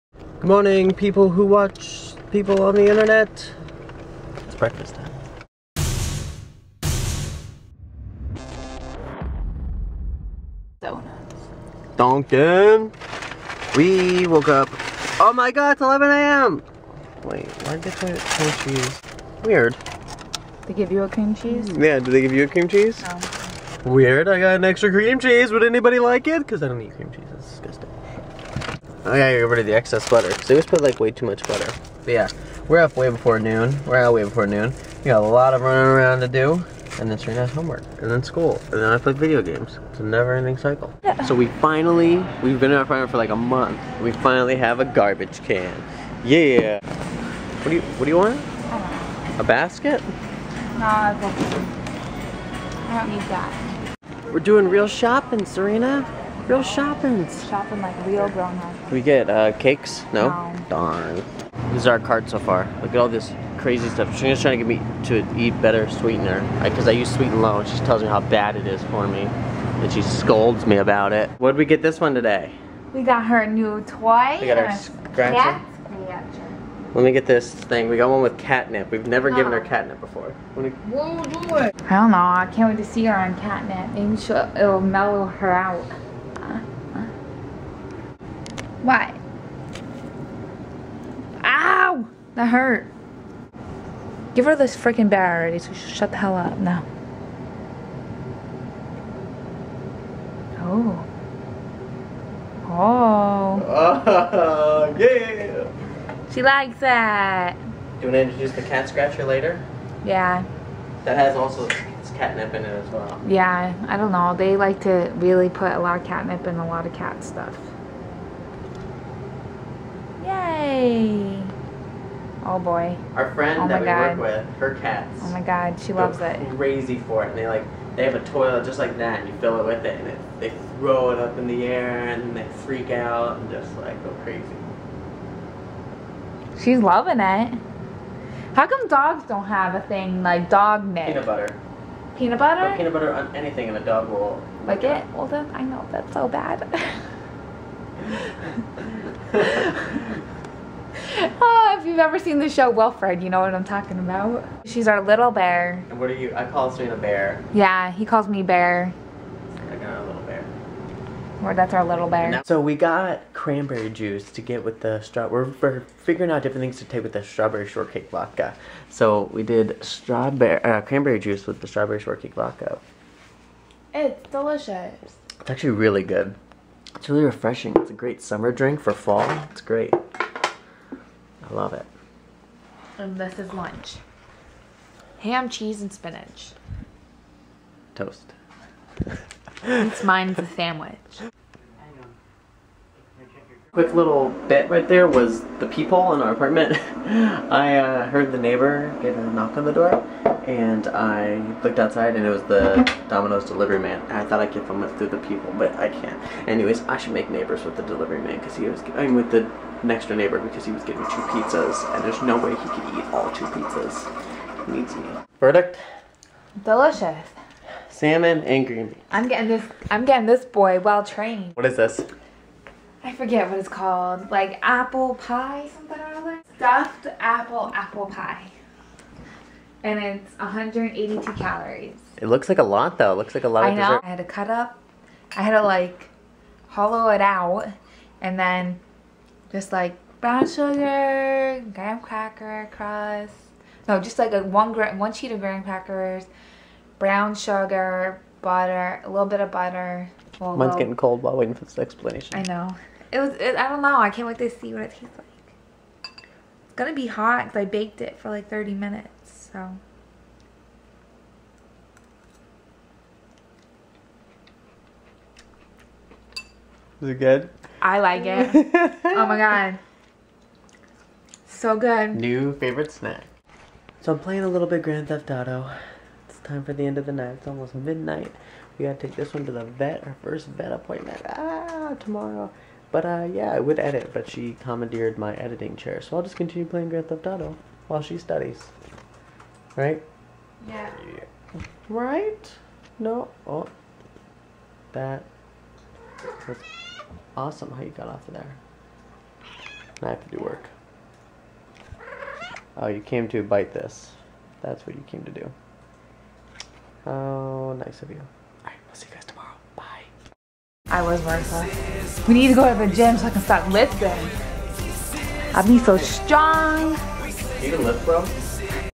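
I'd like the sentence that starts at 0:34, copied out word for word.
We got a lot of running around to do.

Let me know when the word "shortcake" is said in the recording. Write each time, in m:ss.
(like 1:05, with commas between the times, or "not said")
2:47, 2:51.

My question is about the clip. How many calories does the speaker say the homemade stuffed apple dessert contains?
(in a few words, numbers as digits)
182.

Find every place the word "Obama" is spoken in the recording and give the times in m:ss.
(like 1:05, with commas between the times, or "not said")
not said.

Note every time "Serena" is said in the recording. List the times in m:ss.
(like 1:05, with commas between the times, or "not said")
0:37, 0:55, 2:36.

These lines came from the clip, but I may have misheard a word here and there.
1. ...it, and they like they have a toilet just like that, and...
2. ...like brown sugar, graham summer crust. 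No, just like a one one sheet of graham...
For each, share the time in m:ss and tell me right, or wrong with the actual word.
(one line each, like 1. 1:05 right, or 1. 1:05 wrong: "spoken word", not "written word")
1. 2:07 right
2. 3:59 wrong: "cracker", not "summer".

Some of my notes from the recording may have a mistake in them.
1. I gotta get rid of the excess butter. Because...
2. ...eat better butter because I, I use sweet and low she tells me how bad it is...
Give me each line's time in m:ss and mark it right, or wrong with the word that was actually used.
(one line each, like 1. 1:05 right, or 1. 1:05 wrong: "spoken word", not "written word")
1. 0:29 right
2. 1:05 wrong: "sweetener", not "butter".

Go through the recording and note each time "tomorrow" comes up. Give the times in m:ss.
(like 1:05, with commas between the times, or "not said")
4:41, 5:09.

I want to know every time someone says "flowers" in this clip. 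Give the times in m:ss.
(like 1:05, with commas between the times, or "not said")
not said.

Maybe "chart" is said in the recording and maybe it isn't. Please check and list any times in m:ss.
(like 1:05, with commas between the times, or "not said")
not said.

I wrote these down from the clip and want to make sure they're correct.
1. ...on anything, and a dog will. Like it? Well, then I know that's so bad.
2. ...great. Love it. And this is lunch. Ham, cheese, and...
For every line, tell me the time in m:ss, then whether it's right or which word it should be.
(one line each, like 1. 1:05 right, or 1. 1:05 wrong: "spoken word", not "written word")
1. 2:23 right
2. 2:59 right.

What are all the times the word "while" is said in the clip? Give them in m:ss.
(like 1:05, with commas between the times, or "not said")
4:11, 4:47.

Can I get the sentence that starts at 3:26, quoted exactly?
Anyways, I should make neighbors with the delivery man because he was.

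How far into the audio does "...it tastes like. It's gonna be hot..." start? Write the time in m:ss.
4:14.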